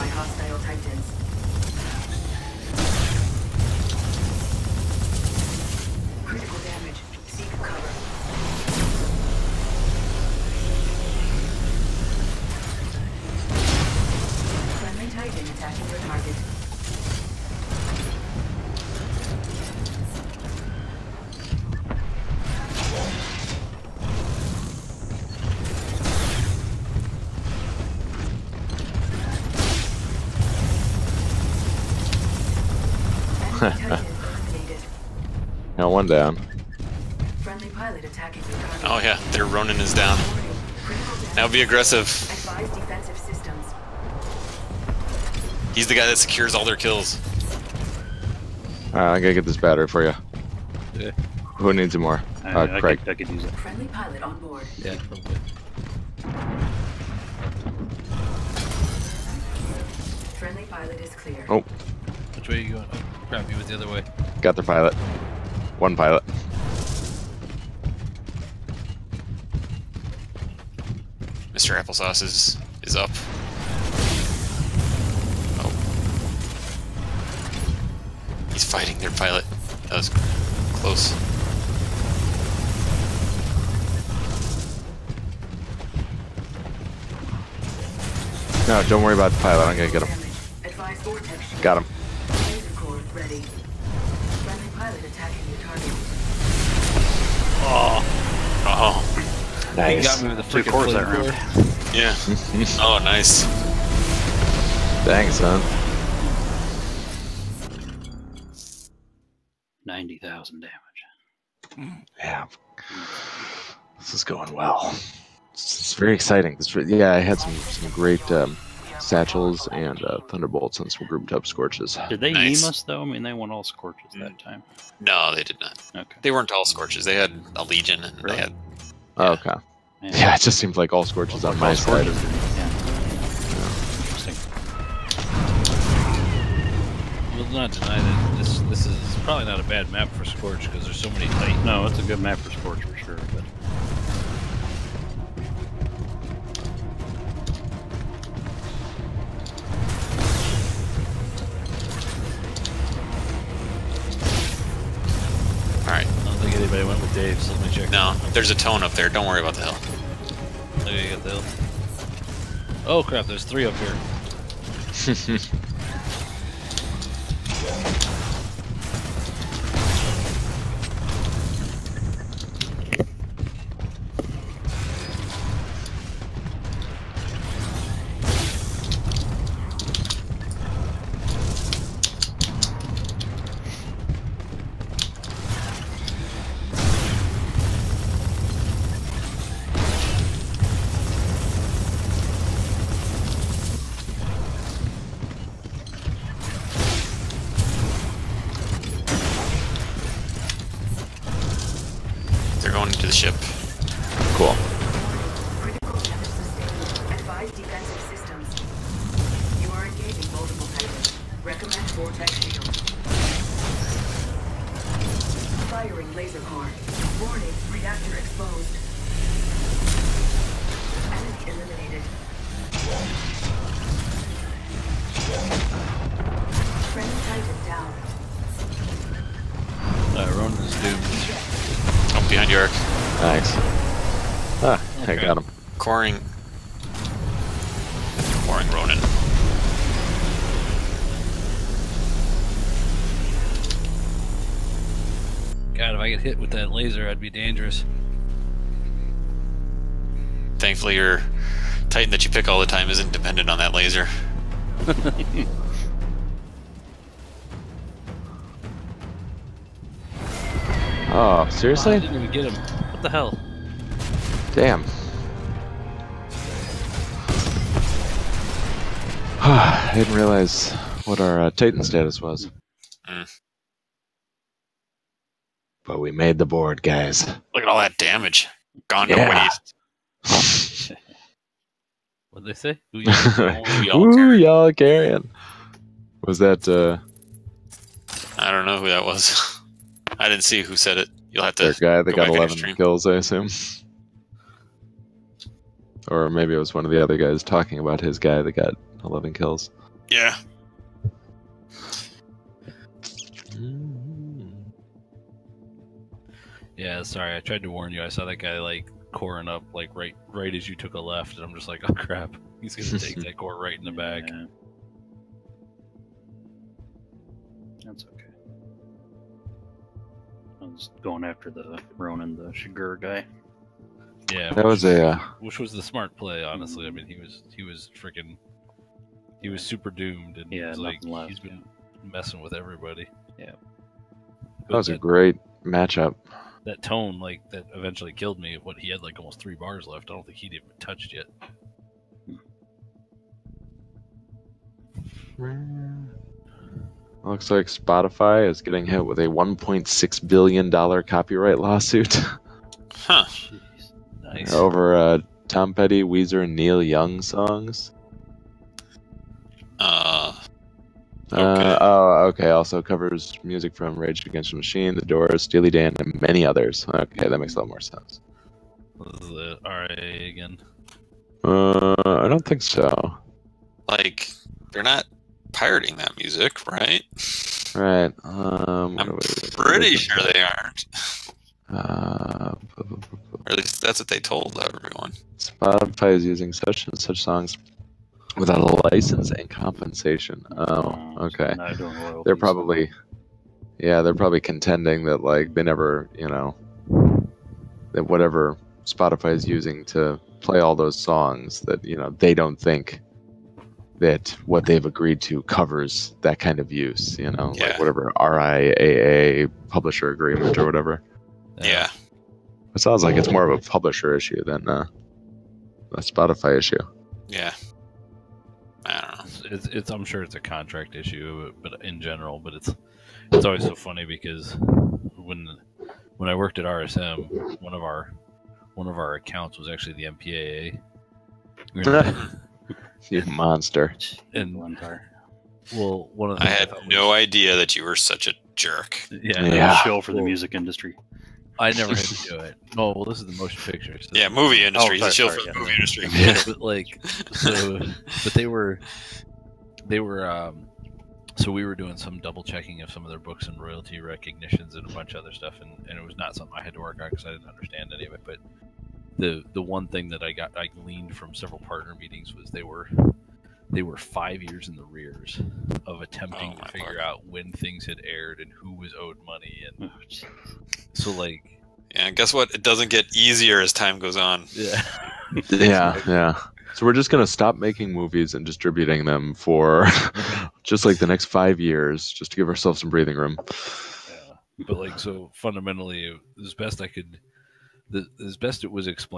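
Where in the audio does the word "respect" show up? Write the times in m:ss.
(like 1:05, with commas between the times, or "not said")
not said.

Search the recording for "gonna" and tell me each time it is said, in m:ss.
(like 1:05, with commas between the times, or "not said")
1:29, 5:12, 7:57.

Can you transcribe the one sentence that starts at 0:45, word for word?
He's the guy that secures all their kills.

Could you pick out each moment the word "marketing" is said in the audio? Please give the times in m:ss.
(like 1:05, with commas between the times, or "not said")
not said.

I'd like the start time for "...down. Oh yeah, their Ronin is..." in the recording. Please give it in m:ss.
0:36.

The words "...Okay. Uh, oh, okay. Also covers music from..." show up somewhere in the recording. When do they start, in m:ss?
6:01.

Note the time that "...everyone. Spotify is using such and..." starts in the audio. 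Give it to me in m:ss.
6:24.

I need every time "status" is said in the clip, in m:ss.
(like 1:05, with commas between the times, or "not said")
4:31.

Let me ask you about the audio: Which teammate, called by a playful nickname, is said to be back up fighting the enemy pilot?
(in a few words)
Mr. Applesauce.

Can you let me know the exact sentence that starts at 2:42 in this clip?
Oh crap, there's three up here.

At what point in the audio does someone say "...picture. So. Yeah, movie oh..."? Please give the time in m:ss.
7:23.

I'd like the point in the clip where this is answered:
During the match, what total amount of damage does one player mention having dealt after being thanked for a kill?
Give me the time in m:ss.
1:49.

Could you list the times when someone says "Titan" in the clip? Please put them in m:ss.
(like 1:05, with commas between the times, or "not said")
4:11, 4:31.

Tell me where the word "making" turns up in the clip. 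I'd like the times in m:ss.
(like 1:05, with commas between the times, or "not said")
7:57.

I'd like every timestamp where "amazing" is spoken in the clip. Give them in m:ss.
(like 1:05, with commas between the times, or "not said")
not said.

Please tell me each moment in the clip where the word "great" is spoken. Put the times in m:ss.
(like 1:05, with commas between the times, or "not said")
1:57, 5:34.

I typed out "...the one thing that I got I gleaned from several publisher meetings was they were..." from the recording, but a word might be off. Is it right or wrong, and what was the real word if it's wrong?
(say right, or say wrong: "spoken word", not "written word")
wrong: "partner", not "publisher".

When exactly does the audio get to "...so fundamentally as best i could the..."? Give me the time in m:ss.
8:04.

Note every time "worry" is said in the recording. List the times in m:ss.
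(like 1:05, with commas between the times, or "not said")
1:29, 2:39.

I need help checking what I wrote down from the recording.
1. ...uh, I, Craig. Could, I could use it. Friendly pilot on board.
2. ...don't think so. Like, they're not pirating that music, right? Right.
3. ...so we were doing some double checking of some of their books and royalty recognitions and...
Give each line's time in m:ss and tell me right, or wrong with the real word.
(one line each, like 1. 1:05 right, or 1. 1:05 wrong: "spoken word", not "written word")
1. 0:52 right
2. 6:12 right
3. 7:31 right.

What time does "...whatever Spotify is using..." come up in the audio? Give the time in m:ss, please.
6:38.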